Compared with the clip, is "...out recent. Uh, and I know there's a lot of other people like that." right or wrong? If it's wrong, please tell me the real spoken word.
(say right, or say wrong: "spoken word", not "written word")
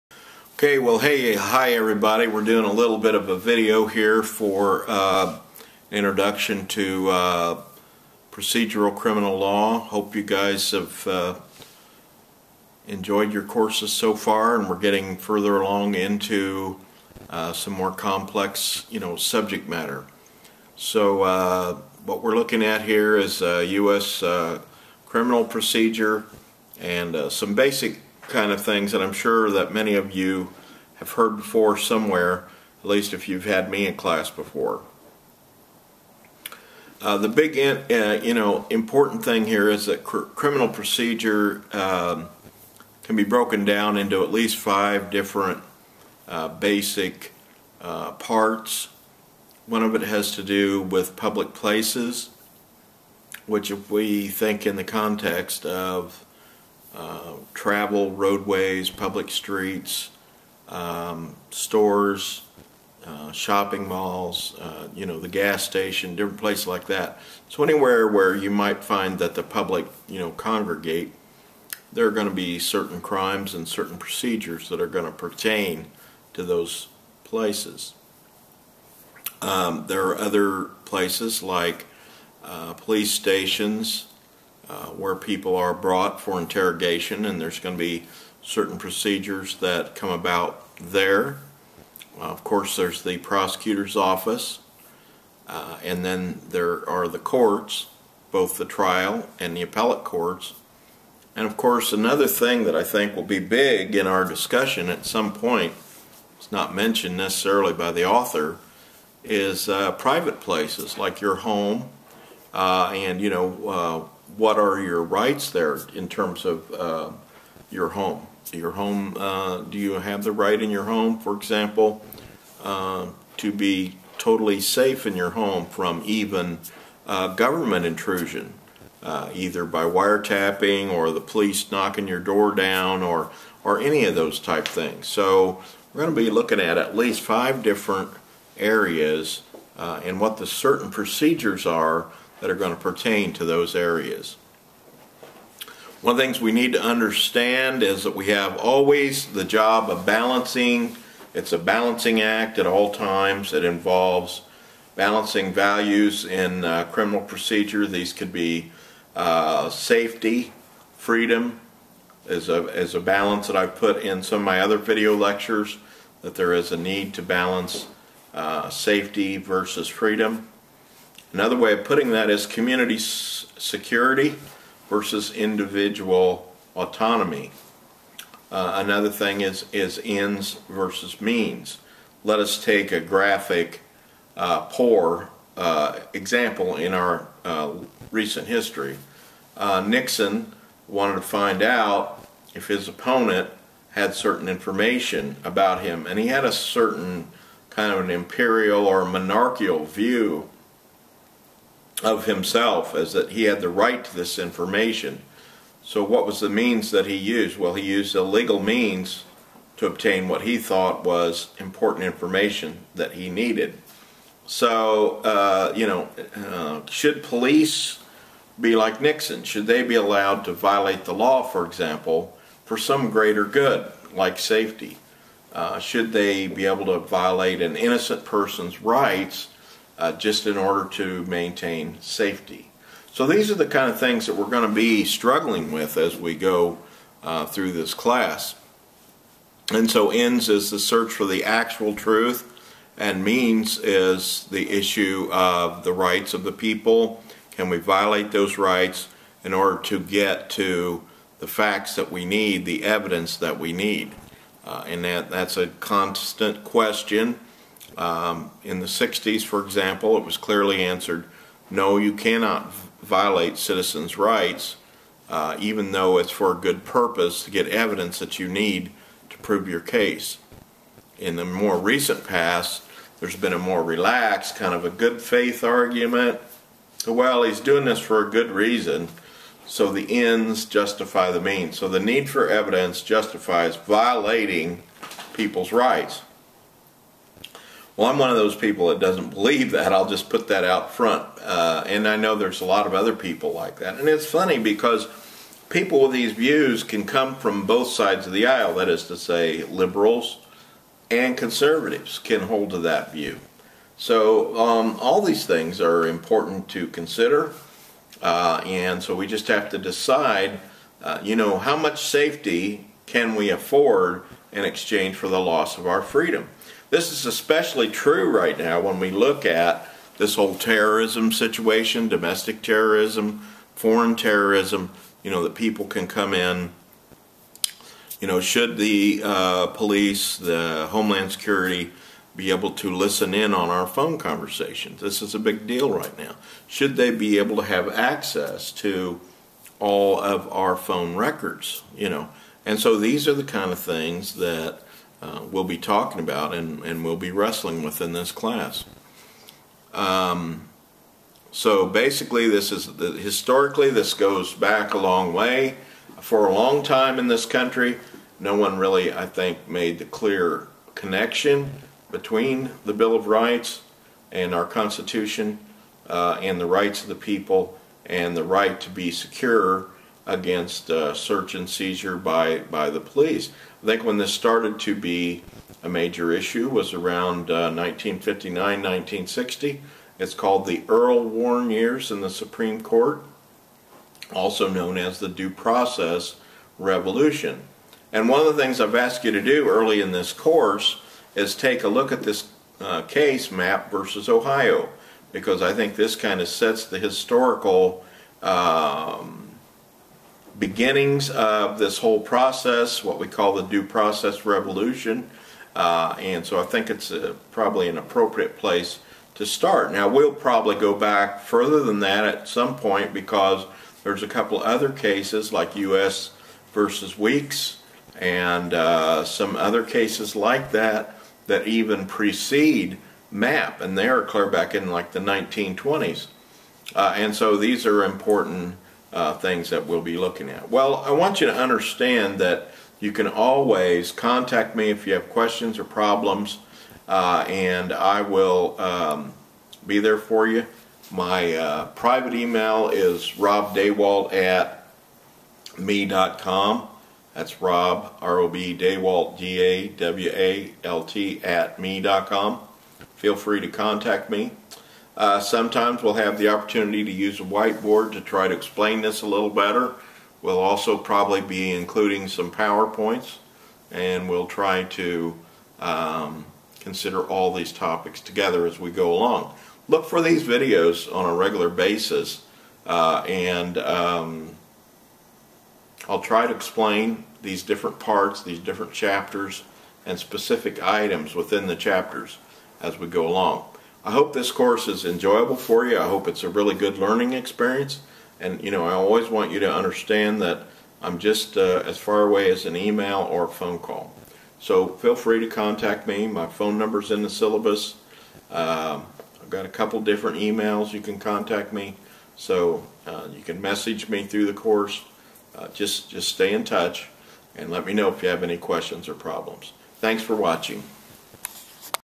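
wrong: "front", not "recent".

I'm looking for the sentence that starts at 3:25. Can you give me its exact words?
So what was the means that he used?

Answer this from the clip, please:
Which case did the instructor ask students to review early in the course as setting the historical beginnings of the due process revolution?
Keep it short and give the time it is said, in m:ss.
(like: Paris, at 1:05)
Mapp versus Ohio, at 6:33.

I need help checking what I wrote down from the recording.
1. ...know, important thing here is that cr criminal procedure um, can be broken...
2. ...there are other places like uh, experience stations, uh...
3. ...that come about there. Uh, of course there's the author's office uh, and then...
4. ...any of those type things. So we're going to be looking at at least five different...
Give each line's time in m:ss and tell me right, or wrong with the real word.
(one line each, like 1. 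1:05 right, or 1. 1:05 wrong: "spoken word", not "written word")
1. 0:38 right
2. 1:19 wrong: "police", not "experience"
3. 1:29 wrong: "prosecutor", not "author"
4. 2:13 right.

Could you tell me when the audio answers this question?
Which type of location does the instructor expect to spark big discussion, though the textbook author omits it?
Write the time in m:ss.
1:49.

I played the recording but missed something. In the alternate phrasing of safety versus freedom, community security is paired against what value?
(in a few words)
Individual autonomy.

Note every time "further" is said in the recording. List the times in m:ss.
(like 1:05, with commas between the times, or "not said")
0:15, 6:51.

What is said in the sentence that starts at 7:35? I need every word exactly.
Uh, sometimes we'll have the opportunity to use a whiteboard to try to explain this a little better.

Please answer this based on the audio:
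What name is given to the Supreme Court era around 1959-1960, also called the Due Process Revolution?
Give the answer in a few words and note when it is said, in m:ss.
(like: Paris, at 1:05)
Earl Warren years, at 6:20.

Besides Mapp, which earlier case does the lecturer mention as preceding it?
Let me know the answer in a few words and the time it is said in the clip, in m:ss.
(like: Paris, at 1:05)
U.S. versus Weeks, at 6:55.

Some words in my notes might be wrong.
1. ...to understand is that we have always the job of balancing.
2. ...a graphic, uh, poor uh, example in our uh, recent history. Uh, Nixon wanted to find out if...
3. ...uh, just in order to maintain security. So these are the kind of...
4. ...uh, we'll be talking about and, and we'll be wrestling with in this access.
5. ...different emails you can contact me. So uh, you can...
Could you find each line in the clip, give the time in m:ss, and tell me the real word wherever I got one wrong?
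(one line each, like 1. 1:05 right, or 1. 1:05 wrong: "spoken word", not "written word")
1. 2:26 right
2. 3:02 right
3. 3:50 wrong: "safety", not "security"
4. 5:45 wrong: "class", not "access"
5. 8:20 right.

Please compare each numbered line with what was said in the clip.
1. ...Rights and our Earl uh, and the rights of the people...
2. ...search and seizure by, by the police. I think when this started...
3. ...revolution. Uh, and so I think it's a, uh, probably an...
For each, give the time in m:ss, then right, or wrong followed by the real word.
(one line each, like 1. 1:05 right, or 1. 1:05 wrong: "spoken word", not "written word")
1. 6:03 wrong: "Constitution", not "Earl"
2. 6:11 right
3. 6:44 right.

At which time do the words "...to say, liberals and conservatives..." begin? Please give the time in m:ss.
4:59.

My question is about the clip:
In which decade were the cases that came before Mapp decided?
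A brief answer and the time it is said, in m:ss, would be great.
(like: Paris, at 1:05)
1920s, at 7:05.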